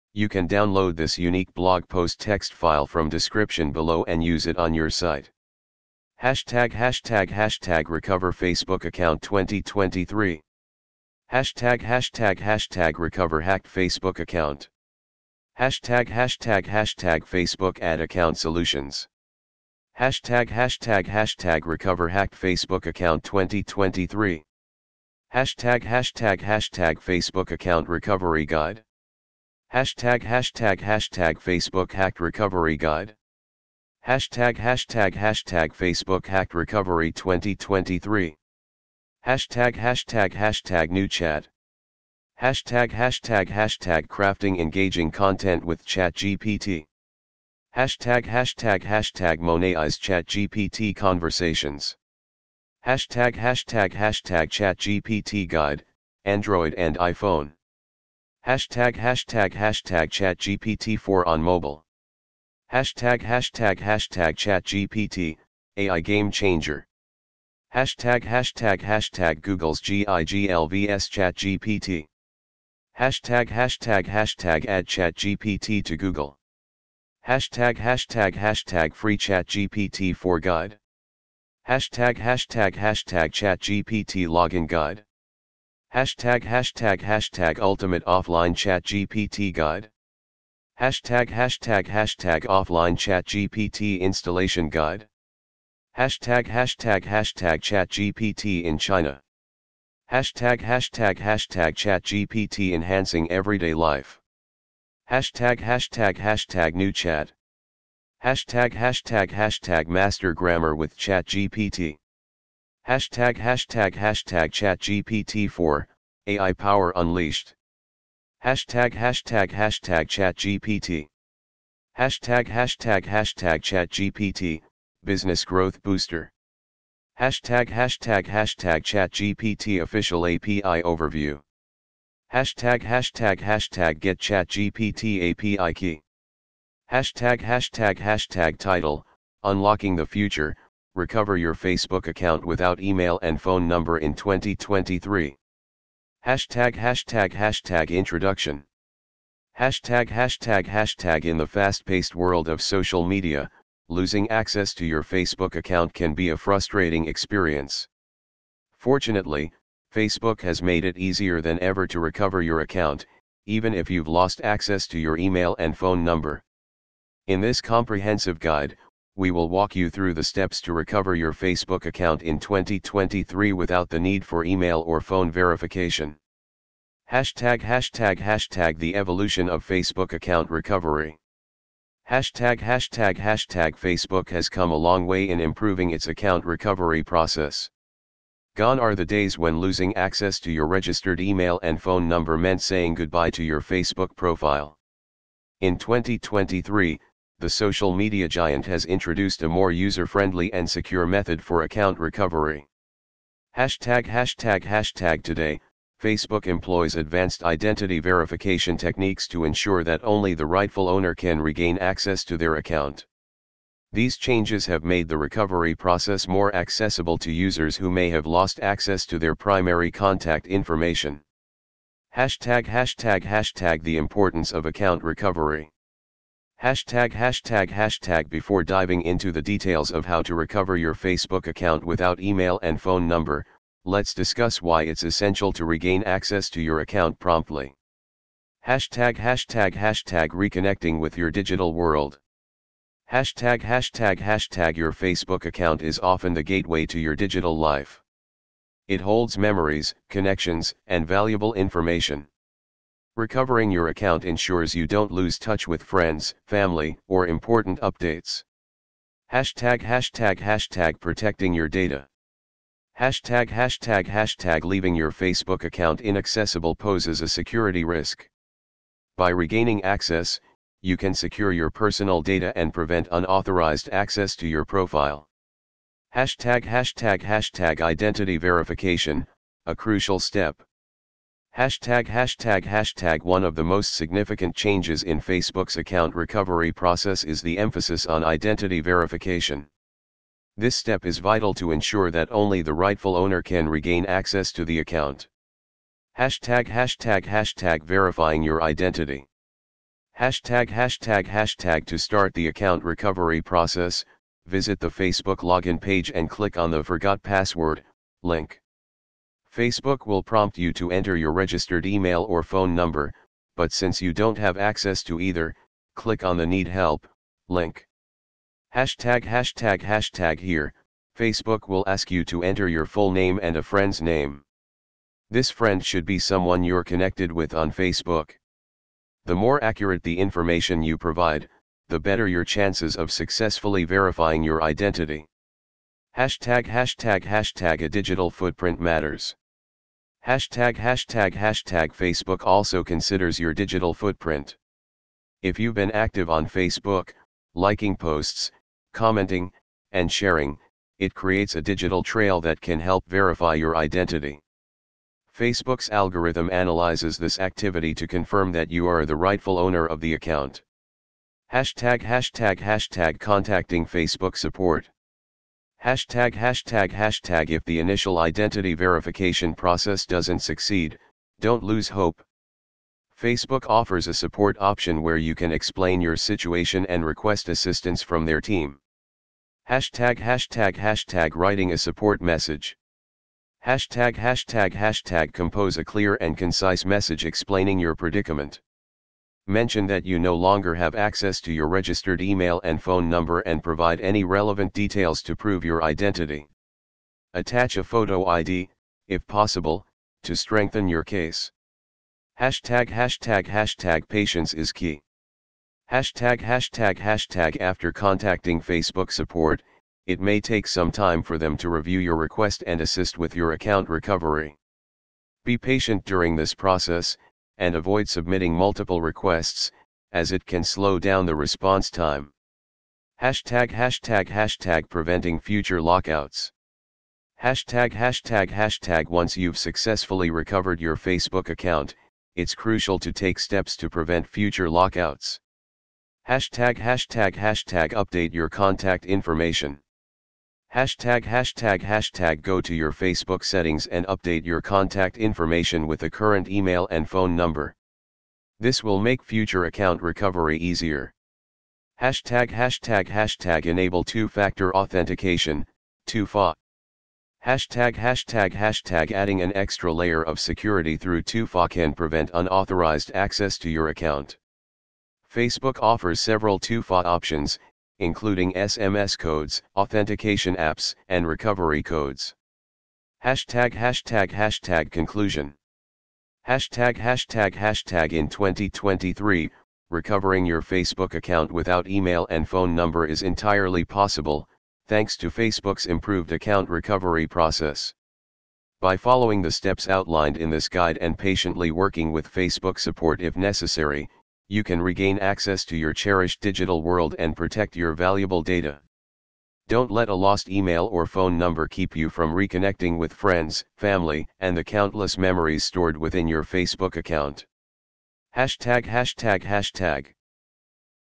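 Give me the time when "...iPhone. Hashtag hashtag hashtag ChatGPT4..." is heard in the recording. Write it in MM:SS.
00:56.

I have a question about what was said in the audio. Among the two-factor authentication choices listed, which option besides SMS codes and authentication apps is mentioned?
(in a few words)
recovery codes.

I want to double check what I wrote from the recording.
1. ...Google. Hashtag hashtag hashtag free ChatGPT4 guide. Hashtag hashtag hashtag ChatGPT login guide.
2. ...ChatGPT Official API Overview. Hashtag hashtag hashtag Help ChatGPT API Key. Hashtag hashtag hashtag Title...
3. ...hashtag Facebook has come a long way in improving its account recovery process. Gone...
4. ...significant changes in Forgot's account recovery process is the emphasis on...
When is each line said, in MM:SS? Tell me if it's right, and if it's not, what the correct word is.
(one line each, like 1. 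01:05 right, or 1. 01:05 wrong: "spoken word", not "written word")
1. 01:15 right
2. 02:08 wrong: "Get", not "Help"
3. 03:03 right
4. 04:43 wrong: "Facebook", not "Forgot".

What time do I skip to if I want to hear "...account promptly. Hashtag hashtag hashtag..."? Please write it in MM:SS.
03:56.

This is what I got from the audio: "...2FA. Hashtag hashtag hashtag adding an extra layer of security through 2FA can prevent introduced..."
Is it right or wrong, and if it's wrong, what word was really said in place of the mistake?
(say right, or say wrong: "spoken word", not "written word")
wrong: "unauthorized", not "introduced".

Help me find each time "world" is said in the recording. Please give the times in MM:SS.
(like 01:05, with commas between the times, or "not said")
02:32, 04:01, 08:16.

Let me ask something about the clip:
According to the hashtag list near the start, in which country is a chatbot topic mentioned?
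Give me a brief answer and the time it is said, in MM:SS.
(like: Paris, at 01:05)
China, at 01:38.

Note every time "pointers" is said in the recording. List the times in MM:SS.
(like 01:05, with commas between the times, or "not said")
not said.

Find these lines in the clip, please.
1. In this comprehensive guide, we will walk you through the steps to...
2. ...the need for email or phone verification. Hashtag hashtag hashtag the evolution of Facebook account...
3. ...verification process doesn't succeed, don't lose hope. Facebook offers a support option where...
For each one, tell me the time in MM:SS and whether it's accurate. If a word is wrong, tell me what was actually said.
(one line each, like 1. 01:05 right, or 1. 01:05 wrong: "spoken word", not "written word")
1. 02:47 right
2. 02:53 right
3. 06:08 right.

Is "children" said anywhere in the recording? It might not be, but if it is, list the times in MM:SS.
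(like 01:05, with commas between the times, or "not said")
not said.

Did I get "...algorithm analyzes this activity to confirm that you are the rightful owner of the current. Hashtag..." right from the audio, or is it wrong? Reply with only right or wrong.
wrong.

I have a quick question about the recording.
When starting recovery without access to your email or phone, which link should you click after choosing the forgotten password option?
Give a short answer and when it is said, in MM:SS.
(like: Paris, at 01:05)
Need Help, at 05:16.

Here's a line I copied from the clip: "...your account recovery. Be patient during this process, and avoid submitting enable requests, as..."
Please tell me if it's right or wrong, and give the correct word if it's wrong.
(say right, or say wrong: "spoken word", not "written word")
wrong: "multiple", not "enable".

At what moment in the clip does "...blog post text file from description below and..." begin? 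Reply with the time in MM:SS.
00:01.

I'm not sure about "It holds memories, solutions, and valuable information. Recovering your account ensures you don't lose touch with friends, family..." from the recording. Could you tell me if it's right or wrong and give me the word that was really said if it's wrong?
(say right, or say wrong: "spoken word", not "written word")
wrong: "connections", not "solutions".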